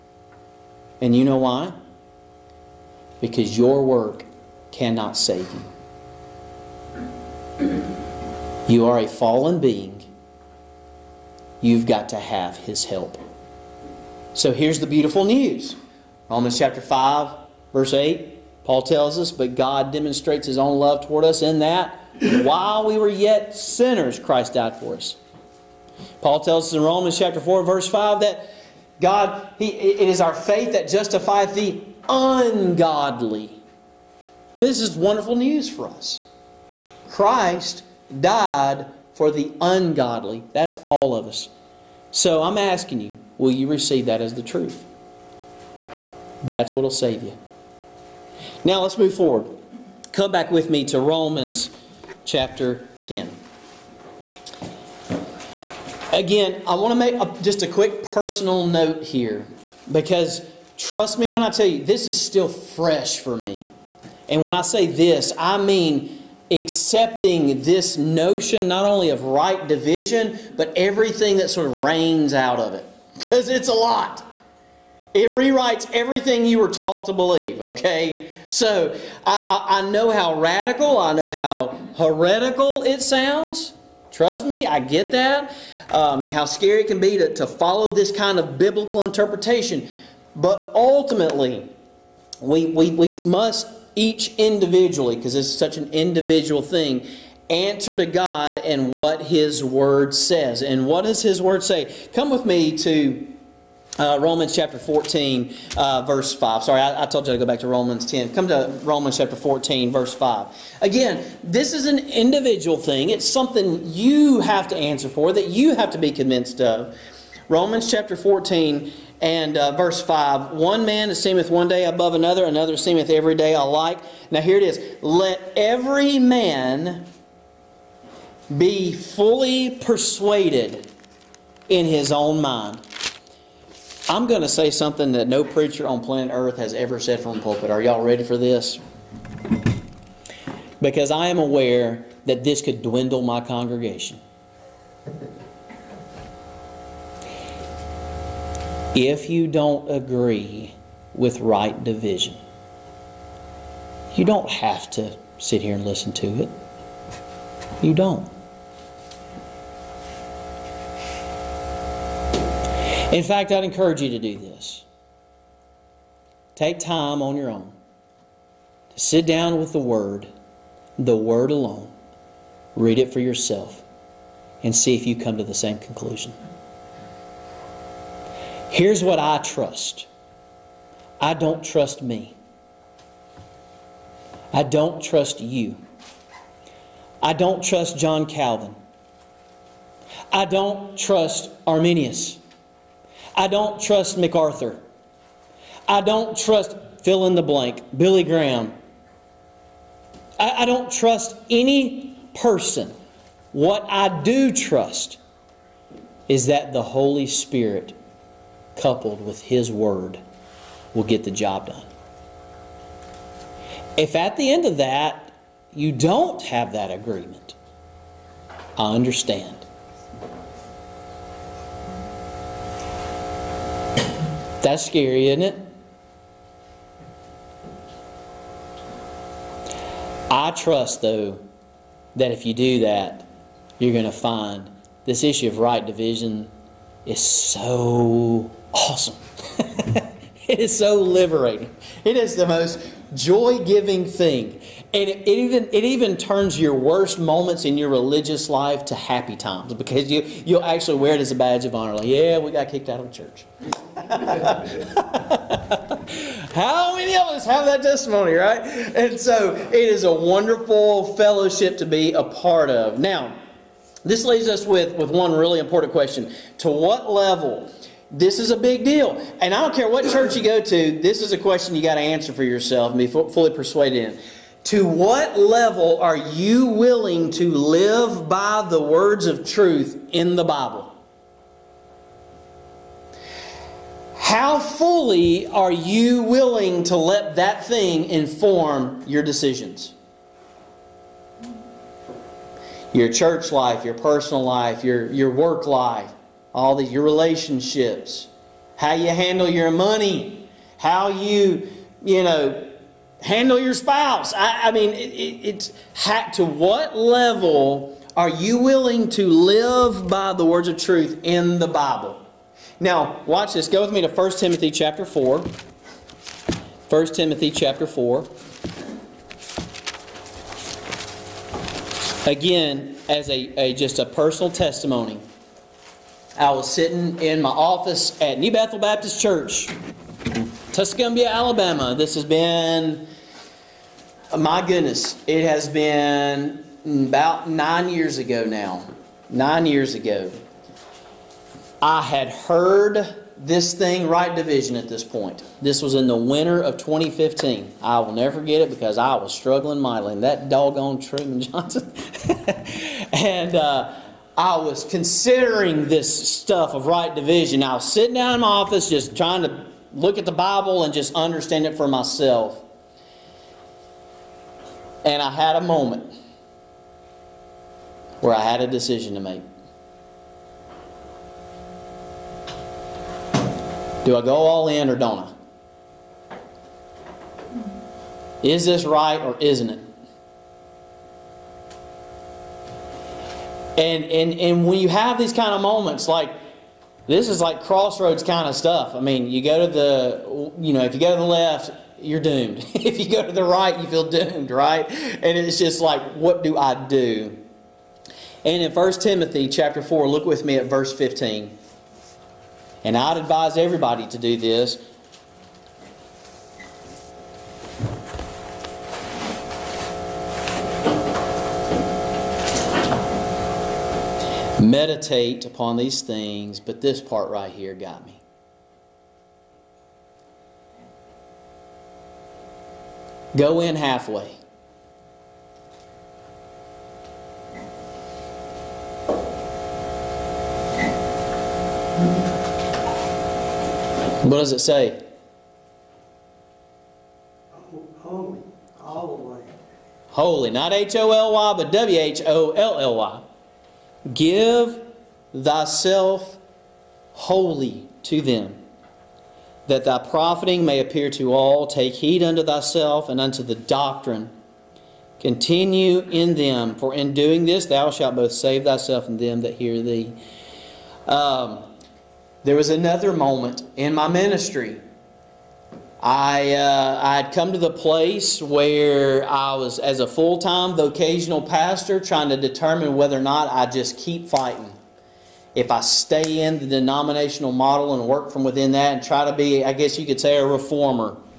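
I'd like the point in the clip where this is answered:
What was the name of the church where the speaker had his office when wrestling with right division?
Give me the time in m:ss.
5:28.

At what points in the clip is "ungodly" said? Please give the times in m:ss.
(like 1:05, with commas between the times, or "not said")
0:32, 0:39.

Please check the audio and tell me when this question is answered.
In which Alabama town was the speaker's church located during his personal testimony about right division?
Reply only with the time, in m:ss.
5:30.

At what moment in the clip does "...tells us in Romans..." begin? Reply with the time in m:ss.
0:26.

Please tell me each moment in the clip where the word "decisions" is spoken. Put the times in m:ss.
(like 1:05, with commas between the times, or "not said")
4:49, 6:08.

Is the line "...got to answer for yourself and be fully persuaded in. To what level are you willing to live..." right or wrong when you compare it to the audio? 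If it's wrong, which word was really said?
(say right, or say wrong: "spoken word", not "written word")
right.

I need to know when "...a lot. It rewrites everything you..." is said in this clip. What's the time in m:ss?
1:13.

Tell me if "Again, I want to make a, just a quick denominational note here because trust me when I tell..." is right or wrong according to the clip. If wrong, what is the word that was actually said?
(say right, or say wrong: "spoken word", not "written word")
wrong: "personal", not "denominational".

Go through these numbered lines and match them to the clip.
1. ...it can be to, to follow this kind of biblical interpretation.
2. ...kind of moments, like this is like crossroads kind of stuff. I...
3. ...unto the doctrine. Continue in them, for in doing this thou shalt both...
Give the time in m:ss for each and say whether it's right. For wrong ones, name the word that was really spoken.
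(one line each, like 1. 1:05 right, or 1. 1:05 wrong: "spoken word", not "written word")
1. 1:26 right
2. 6:25 right
3. 7:33 right.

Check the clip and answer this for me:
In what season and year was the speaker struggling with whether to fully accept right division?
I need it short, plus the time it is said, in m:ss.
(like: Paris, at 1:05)
winter of 2015, at 5:46.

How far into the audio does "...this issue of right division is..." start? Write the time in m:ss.
3:55.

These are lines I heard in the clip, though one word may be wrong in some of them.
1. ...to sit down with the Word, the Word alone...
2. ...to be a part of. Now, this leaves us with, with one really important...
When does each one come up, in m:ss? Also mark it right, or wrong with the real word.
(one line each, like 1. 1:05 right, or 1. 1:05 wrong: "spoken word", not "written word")
1. 2:48 right
2. 4:21 right.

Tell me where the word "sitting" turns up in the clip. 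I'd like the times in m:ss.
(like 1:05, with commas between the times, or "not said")
5:26, 5:57.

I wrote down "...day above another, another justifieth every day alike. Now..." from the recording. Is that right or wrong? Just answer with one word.
wrong.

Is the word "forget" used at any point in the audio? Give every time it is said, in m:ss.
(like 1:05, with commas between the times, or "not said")
5:48.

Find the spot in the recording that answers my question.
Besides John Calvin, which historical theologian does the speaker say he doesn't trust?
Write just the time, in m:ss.
3:11.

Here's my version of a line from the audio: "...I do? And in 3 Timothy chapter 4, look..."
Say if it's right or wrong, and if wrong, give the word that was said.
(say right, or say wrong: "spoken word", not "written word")
wrong: "1", not "3".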